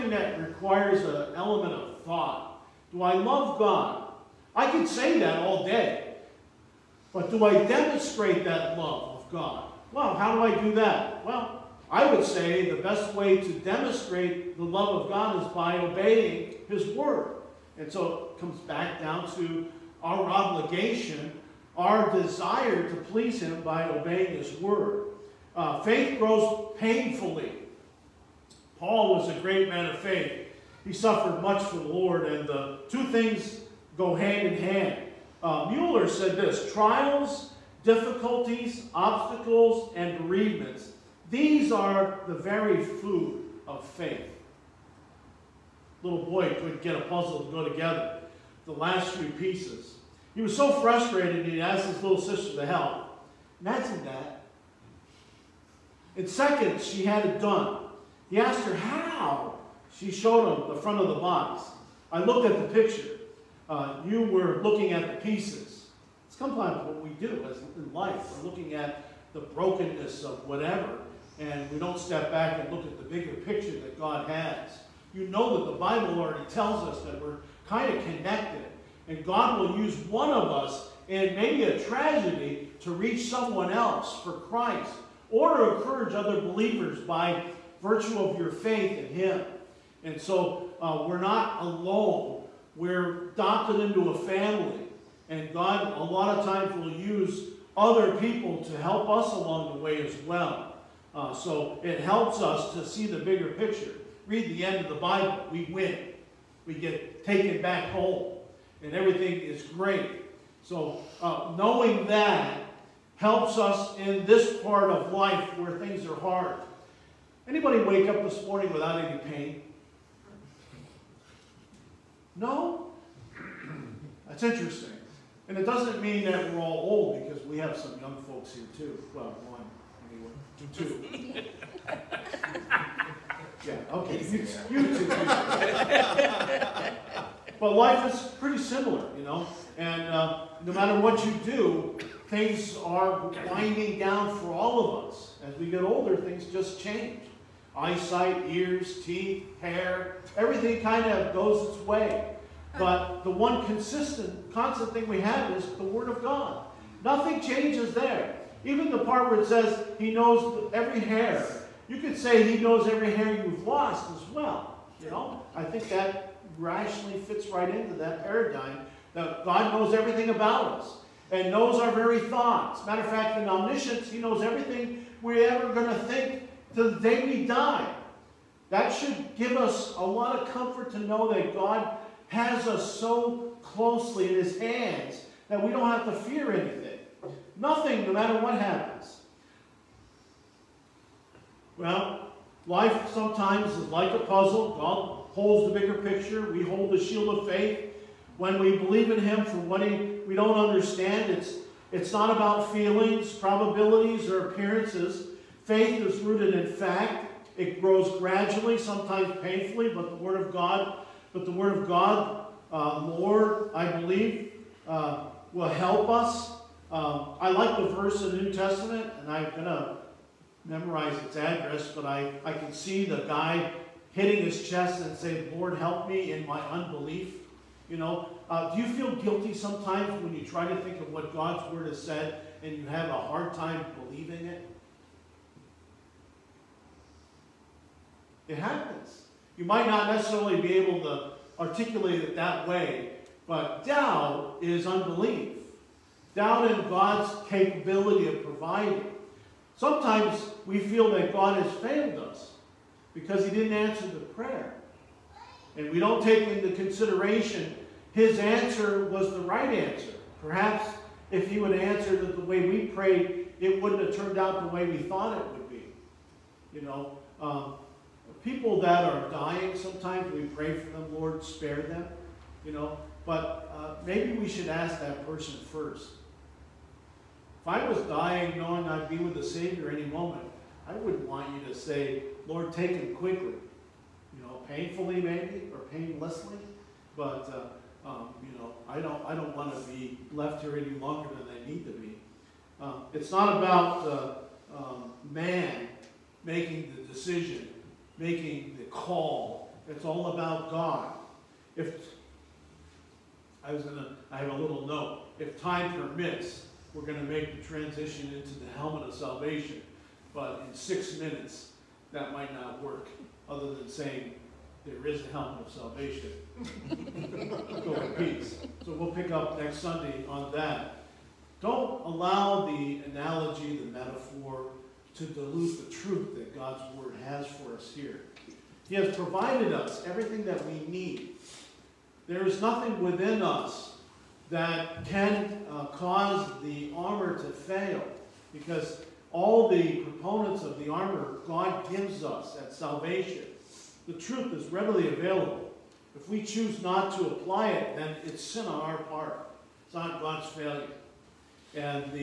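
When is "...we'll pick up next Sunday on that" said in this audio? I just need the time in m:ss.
5:18.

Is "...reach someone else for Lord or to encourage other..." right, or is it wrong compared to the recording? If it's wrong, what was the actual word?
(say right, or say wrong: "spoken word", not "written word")
wrong: "Christ", not "Lord".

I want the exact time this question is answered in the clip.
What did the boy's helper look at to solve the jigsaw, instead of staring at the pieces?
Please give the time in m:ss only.
1:00.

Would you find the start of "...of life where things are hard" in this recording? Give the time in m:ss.
1:54.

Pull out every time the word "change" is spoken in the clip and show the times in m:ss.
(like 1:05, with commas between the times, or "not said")
2:26, 2:37.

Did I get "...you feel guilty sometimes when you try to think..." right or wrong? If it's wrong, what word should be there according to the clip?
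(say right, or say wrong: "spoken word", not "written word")
right.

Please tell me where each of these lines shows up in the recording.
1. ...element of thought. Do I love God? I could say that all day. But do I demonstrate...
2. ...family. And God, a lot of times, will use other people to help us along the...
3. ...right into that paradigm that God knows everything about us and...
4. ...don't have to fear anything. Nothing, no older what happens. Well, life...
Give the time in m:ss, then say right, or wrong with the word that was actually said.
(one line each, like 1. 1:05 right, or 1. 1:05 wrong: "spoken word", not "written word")
1. 0:01 right
2. 1:34 right
3. 2:47 right
4. 3:05 wrong: "matter", not "older".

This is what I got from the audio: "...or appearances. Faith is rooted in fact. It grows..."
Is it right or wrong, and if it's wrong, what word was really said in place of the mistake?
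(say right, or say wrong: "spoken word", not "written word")
right.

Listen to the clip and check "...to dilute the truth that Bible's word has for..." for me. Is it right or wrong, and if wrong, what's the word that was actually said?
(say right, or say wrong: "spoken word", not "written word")
wrong: "God", not "Bible".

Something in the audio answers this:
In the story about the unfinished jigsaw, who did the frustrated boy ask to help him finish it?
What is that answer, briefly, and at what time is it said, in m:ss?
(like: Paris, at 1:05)
His little sister, at 0:51.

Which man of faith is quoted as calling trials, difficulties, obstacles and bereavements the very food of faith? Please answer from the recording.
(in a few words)
Mueller.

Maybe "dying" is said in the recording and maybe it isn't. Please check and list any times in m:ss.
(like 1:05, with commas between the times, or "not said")
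4:29, 4:38.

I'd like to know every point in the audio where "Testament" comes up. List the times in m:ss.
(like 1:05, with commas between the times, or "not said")
3:38.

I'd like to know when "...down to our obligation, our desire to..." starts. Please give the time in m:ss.
0:18.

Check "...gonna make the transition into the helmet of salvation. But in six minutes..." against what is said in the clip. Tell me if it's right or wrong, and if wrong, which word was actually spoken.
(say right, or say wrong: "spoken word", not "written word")
right.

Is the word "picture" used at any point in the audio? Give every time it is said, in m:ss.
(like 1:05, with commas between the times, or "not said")
1:02, 1:13, 1:43, 3:15.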